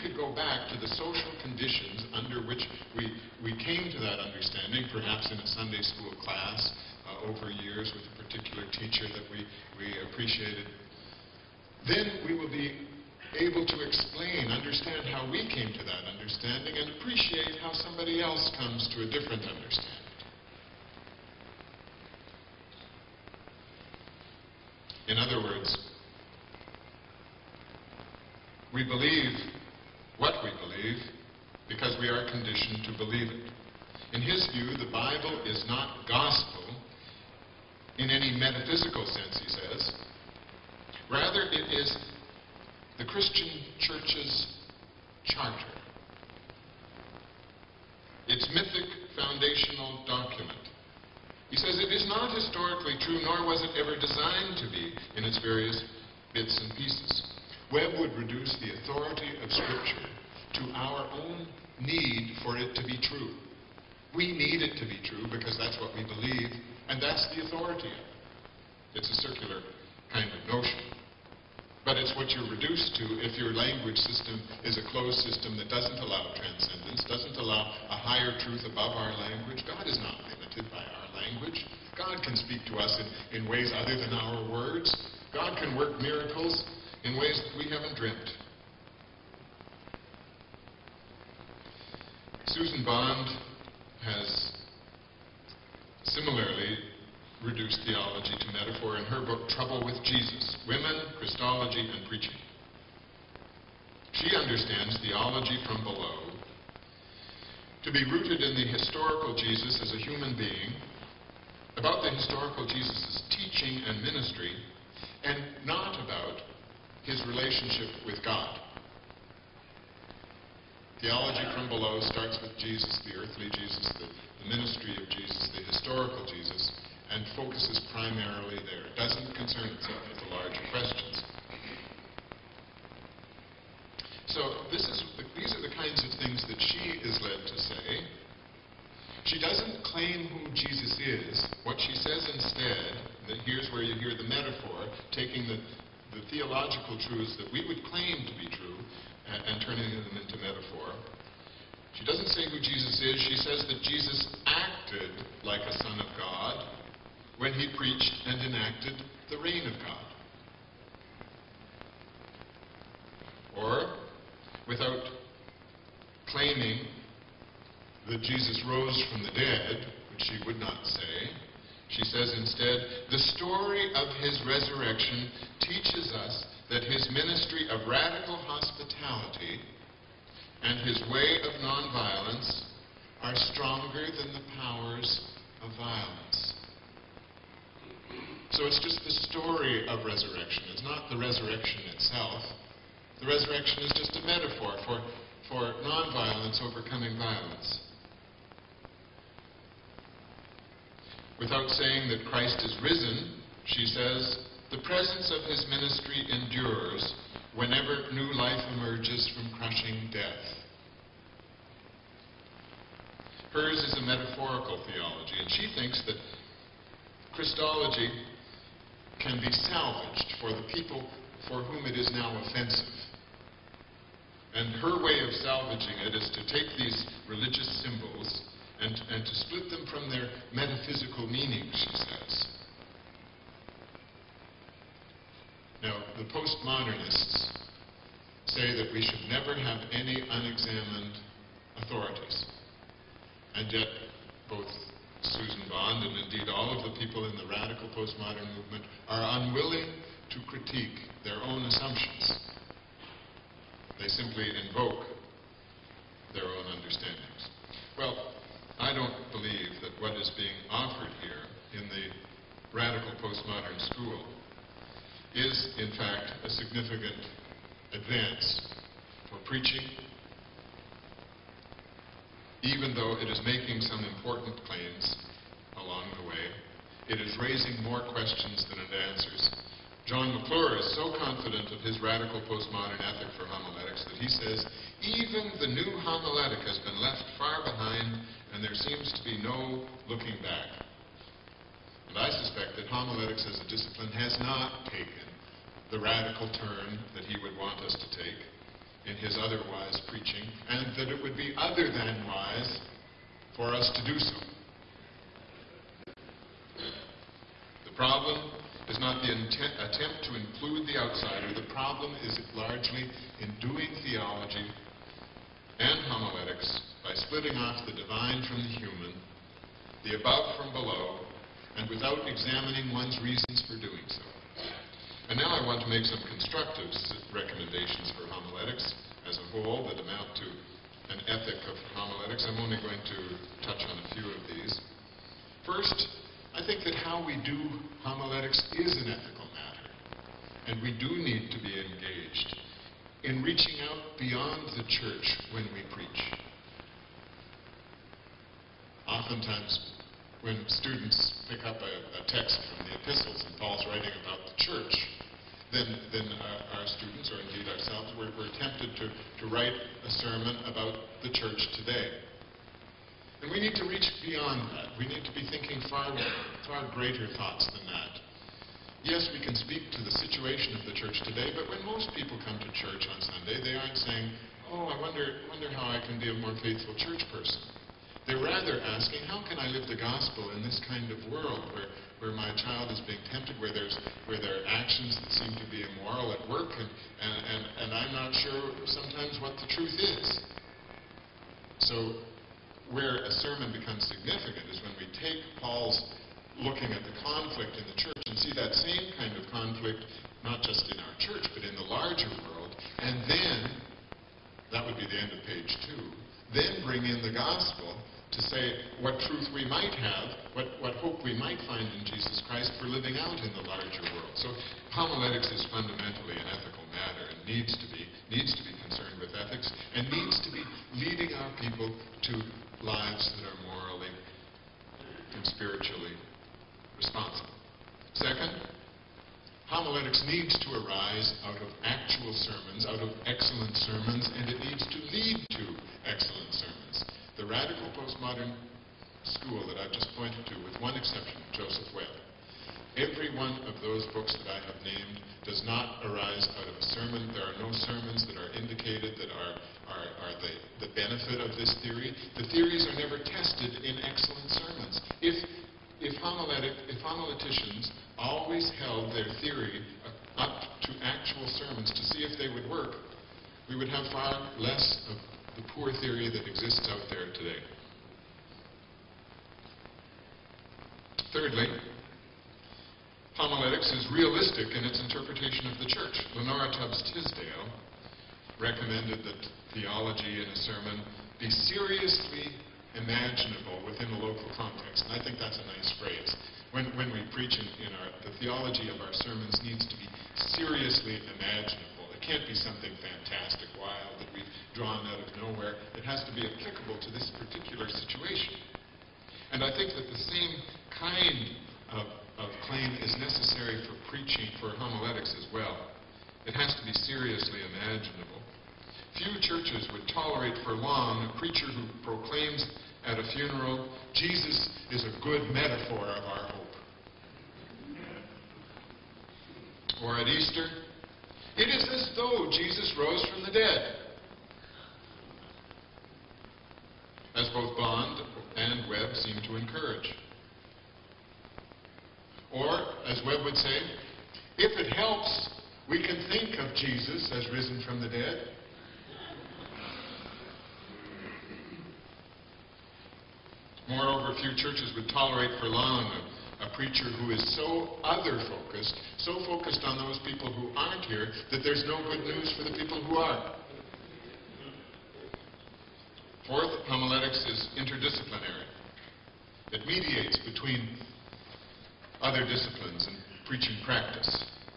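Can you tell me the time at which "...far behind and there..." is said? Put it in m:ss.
4:47.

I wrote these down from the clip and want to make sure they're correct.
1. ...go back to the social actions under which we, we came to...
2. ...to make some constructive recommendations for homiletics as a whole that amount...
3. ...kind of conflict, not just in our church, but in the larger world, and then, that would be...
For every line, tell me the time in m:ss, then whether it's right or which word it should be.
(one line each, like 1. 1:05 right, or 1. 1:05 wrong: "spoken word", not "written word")
1. 0:00 wrong: "conditions", not "actions"
2. 5:25 right
3. 6:39 right.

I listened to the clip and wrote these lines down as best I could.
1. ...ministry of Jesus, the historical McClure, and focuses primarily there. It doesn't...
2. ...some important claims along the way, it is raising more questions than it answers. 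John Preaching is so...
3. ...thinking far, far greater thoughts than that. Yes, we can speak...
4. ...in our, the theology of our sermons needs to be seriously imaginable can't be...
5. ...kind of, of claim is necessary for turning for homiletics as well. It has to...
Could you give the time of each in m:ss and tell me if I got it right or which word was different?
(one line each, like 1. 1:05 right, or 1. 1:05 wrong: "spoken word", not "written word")
1. 2:04 wrong: "Jesus", not "McClure"
2. 4:33 wrong: "McClure", not "Preaching"
3. 6:05 right
4. 8:07 right
5. 8:20 wrong: "preaching", not "turning".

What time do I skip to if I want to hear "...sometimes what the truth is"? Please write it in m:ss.
6:28.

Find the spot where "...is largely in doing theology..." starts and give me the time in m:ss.
5:12.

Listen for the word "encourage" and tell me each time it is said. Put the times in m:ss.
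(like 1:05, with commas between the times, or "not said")
8:49.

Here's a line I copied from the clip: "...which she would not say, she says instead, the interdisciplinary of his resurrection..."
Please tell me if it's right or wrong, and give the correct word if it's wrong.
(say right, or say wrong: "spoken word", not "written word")
wrong: "story", not "interdisciplinary".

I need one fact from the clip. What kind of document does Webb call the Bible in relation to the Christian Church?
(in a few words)
Charter.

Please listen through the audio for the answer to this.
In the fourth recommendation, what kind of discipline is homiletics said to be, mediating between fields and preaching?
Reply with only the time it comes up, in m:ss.
9:17.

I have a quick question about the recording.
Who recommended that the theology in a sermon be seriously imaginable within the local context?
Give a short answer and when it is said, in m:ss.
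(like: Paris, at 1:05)
Lenora Tubbs Tisdale, at 7:56.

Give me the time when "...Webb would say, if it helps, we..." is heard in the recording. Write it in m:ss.
8:53.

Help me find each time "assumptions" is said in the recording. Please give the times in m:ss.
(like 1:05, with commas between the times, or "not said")
4:11.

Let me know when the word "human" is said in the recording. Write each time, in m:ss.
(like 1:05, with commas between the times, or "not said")
1:50, 5:18.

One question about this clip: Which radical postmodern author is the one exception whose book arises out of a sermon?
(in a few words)
Joseph Webb.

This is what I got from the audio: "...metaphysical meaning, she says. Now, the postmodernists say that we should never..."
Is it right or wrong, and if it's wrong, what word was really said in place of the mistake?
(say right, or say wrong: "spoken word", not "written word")
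right.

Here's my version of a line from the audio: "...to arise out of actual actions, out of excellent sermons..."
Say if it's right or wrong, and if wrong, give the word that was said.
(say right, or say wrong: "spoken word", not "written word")
wrong: "sermons", not "actions".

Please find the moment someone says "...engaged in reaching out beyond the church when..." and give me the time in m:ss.
5:41.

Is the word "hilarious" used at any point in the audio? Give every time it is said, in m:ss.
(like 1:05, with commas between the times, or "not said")
not said.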